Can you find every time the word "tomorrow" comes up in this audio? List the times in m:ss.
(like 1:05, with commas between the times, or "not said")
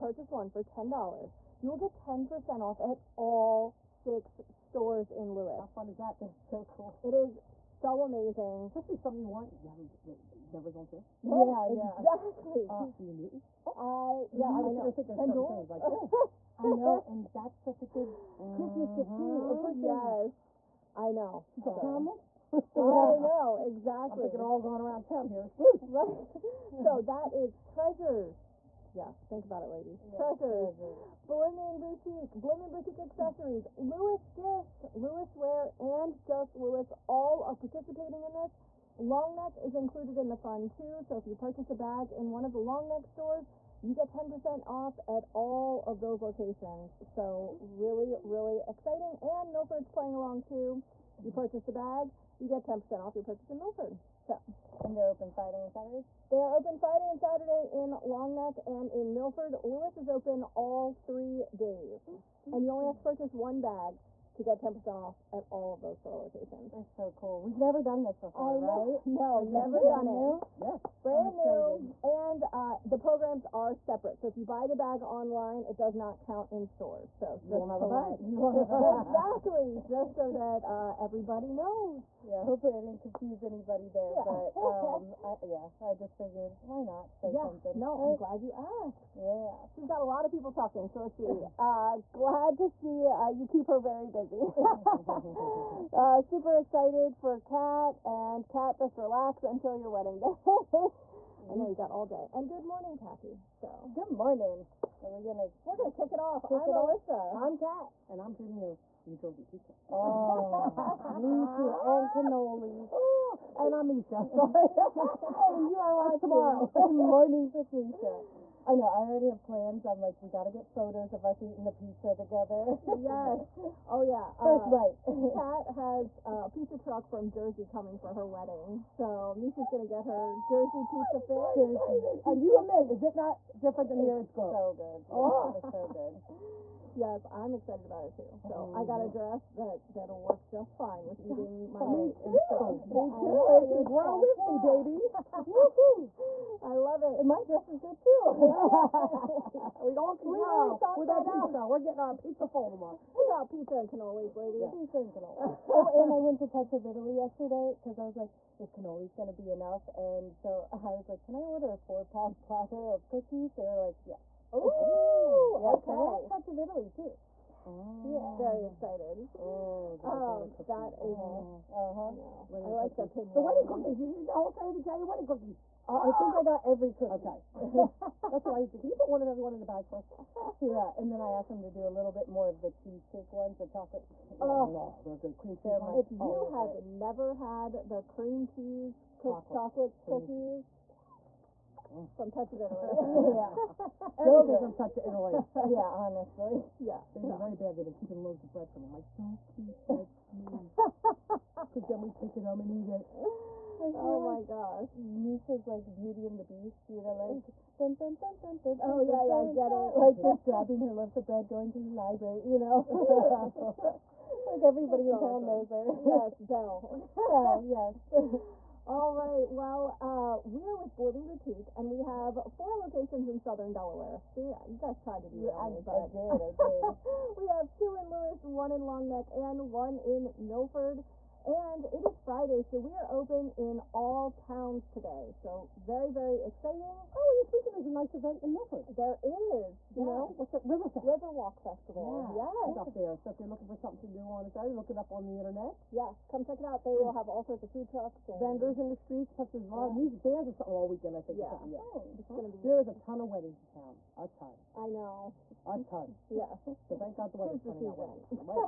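1:56, 2:32.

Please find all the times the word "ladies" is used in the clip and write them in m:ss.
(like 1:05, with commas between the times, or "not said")
0:29, 2:34.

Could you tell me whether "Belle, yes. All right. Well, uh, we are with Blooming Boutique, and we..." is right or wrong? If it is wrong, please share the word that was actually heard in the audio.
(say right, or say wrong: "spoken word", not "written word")
right.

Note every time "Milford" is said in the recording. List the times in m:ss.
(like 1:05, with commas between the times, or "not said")
0:49, 0:53, 0:59, 3:50, 3:58.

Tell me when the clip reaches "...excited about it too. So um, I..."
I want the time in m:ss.
2:17.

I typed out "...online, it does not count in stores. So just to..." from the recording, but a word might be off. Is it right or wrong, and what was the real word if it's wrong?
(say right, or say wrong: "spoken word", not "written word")
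right.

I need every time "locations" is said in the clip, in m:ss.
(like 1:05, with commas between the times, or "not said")
0:46, 1:06, 3:42.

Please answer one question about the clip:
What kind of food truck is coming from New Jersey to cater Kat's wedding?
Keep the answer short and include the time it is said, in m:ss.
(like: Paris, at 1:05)
Pizza truck, at 2:06.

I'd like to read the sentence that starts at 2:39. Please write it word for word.
And so I was like, can I order a four pound platter of cookies?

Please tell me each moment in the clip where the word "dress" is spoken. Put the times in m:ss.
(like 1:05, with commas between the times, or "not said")
2:19, 2:27.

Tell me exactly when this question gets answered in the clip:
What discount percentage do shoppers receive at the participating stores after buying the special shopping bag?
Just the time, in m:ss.
0:01.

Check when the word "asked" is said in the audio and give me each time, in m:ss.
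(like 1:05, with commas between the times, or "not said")
1:28, 3:01.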